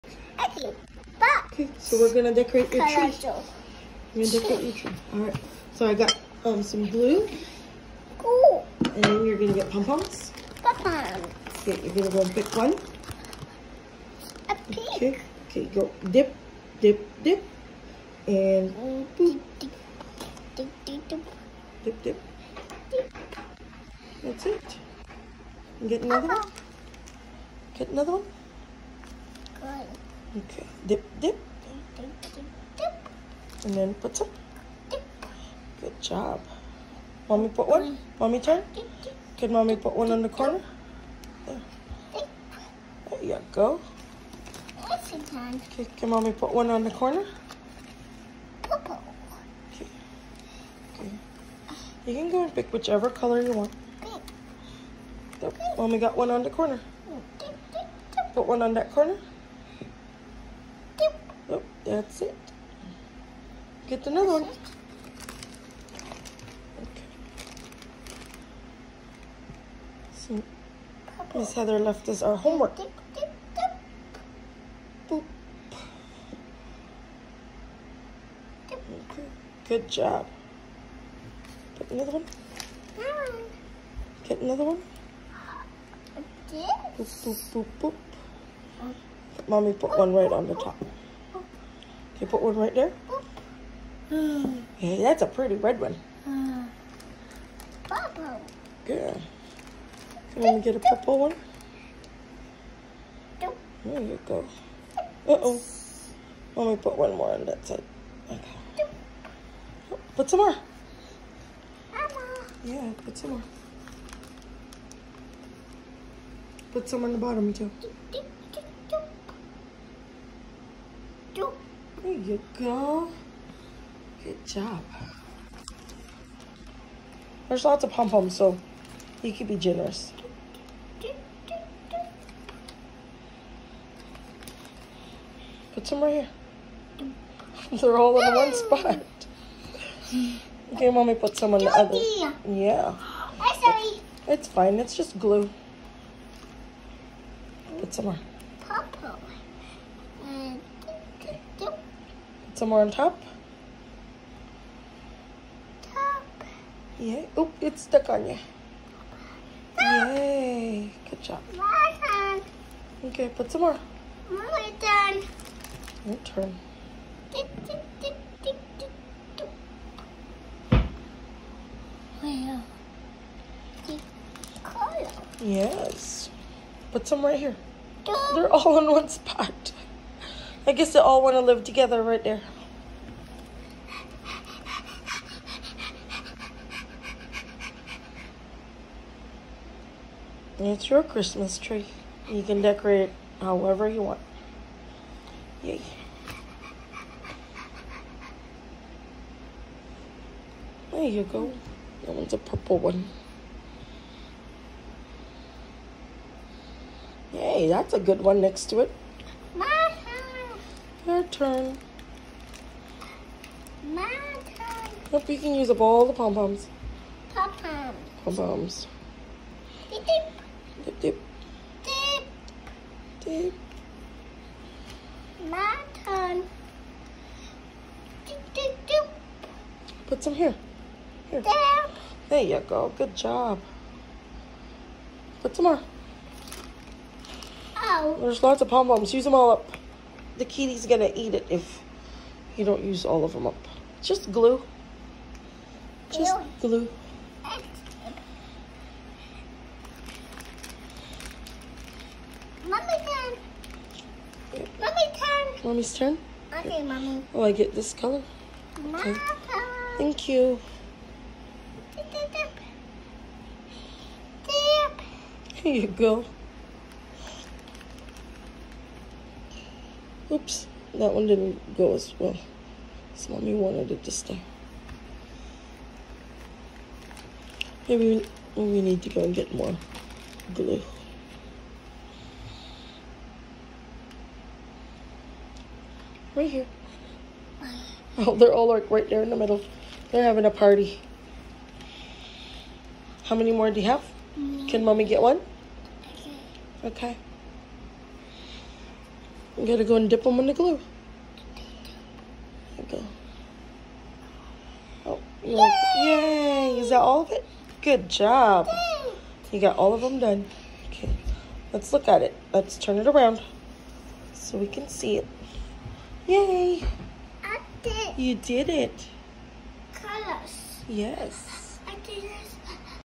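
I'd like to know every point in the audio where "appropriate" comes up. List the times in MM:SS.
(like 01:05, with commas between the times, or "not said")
not said.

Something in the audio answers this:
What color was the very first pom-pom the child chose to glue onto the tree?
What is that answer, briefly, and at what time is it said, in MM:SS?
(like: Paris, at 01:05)
Pink, at 00:14.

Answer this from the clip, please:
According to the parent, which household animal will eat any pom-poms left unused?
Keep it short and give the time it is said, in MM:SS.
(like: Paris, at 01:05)
The kitty, at 04:00.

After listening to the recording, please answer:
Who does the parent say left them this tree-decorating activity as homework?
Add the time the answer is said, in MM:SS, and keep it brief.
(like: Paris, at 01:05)
Miss Heather, at 01:11.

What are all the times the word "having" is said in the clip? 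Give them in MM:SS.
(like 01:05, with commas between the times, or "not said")
04:50.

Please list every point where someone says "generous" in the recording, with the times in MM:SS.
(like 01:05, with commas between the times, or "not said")
02:09.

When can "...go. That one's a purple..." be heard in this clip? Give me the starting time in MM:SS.
03:21.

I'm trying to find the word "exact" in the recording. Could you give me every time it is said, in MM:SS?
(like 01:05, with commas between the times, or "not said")
not said.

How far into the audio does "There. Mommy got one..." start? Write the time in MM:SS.
00:55.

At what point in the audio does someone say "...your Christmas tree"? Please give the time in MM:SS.
03:10.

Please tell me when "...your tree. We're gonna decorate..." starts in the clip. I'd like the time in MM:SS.
00:02.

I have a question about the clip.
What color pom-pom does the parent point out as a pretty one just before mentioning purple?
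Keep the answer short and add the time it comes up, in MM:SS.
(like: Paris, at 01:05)
Red, at 01:35.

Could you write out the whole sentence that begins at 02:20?
Okay, mommy put some on the other.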